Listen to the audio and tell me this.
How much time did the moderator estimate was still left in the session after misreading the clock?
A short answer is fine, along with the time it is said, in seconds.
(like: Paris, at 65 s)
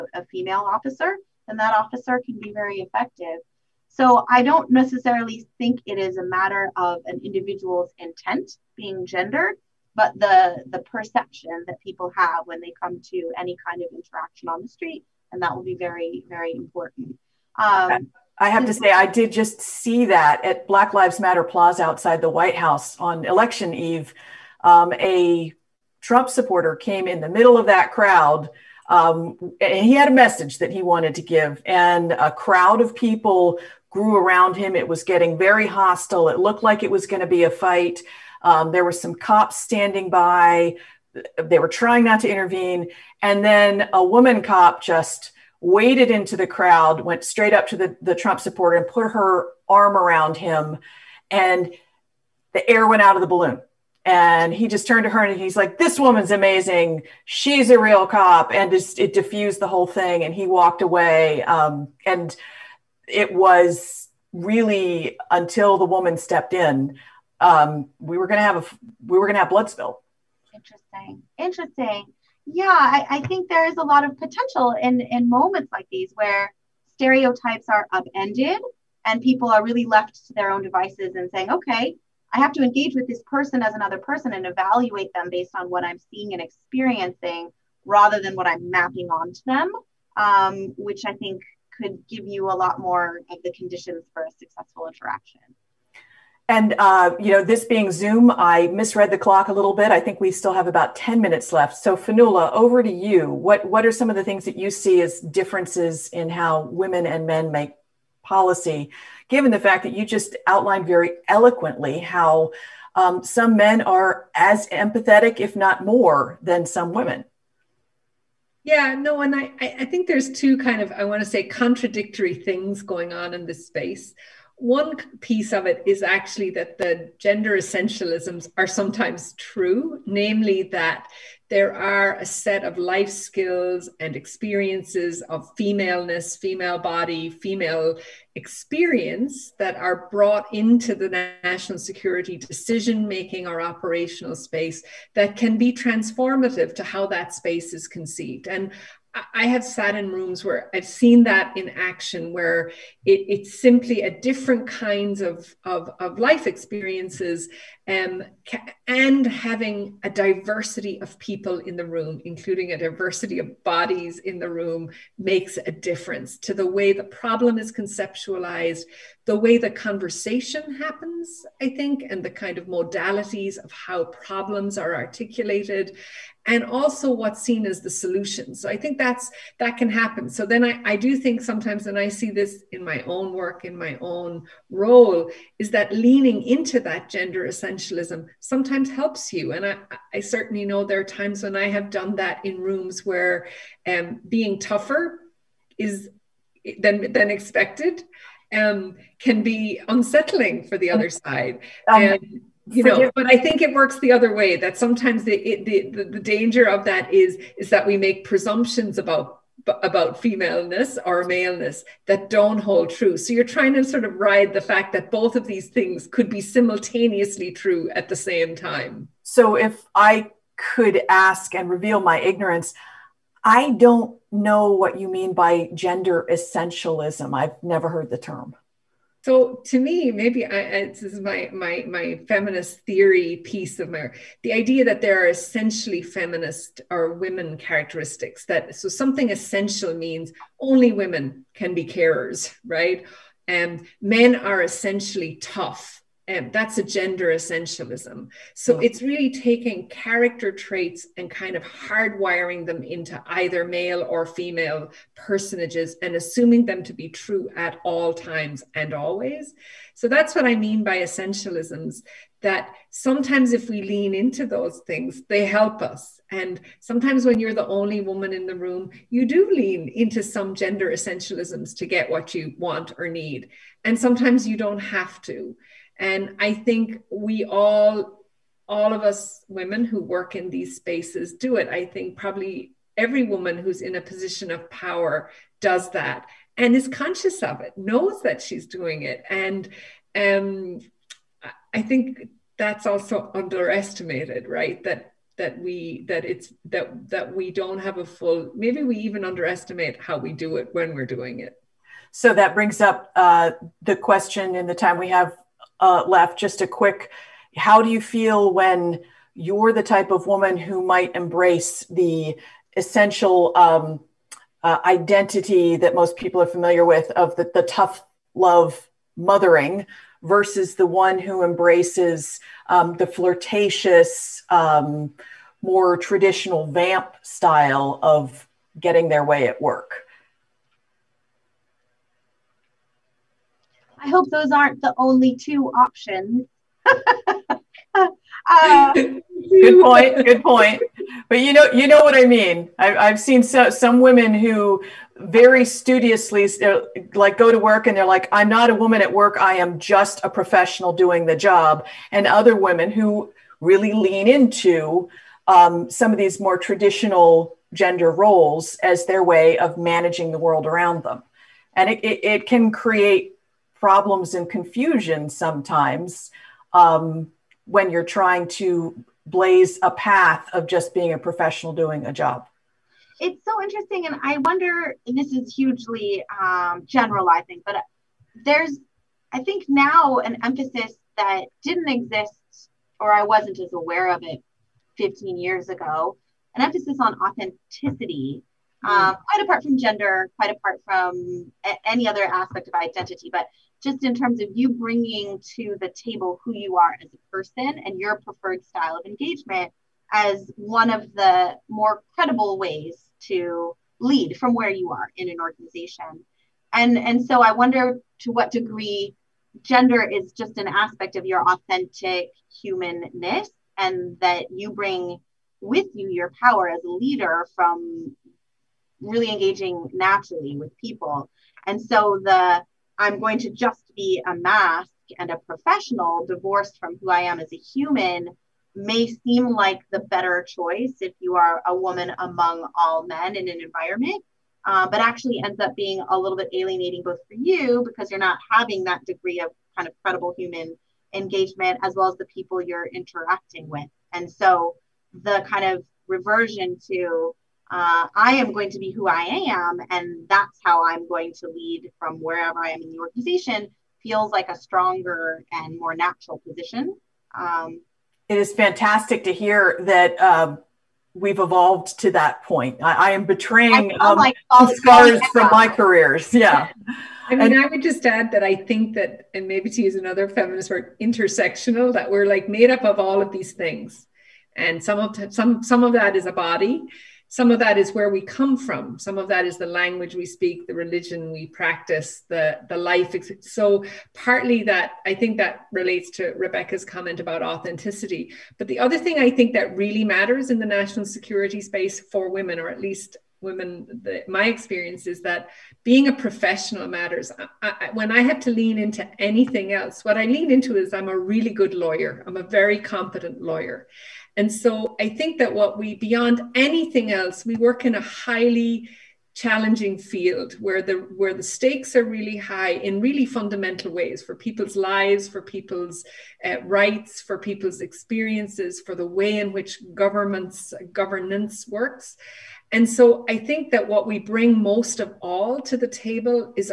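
10 minutes, at 100 s.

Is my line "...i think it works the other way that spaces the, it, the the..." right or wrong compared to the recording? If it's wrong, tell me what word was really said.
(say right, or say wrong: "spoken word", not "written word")
wrong: "sometimes", not "spaces".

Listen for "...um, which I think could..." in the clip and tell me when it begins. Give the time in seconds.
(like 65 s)
90 s.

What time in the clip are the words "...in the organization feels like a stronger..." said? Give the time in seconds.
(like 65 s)
452 s.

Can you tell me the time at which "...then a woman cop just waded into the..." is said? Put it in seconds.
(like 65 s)
43 s.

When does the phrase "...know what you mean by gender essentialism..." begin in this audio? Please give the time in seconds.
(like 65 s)
224 s.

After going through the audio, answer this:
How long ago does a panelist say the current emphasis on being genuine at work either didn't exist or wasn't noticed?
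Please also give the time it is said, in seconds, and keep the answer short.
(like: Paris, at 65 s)
15 years, at 384 s.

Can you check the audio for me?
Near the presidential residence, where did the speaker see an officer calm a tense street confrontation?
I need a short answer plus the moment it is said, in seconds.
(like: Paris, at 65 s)
Black Lives Matter Plaza, at 20 s.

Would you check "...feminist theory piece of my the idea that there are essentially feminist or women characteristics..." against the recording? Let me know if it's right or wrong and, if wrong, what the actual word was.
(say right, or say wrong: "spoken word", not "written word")
right.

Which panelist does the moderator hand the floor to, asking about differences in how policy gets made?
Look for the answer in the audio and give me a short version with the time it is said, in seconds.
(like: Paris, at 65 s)
Fionnuala, at 101 s.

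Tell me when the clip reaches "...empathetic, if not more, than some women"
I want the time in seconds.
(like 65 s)
114 s.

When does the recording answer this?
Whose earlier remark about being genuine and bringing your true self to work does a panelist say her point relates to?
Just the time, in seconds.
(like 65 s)
486 s.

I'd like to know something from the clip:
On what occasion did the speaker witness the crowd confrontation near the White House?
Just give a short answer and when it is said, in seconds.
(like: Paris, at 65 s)
Election eve, at 23 s.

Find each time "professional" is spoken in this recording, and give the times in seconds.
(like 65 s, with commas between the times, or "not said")
350 s, 371 s, 425 s, 496 s.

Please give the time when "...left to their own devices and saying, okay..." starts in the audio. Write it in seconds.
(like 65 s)
79 s.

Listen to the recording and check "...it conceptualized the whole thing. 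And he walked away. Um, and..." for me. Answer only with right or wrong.
wrong.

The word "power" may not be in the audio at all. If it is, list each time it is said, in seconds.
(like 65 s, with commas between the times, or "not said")
284 s, 416 s.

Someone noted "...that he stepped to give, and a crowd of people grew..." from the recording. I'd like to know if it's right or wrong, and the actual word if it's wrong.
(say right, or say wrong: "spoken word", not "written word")
wrong: "wanted", not "stepped".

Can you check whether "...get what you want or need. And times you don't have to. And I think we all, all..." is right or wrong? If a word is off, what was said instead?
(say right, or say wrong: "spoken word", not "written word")
wrong: "sometimes", not "times".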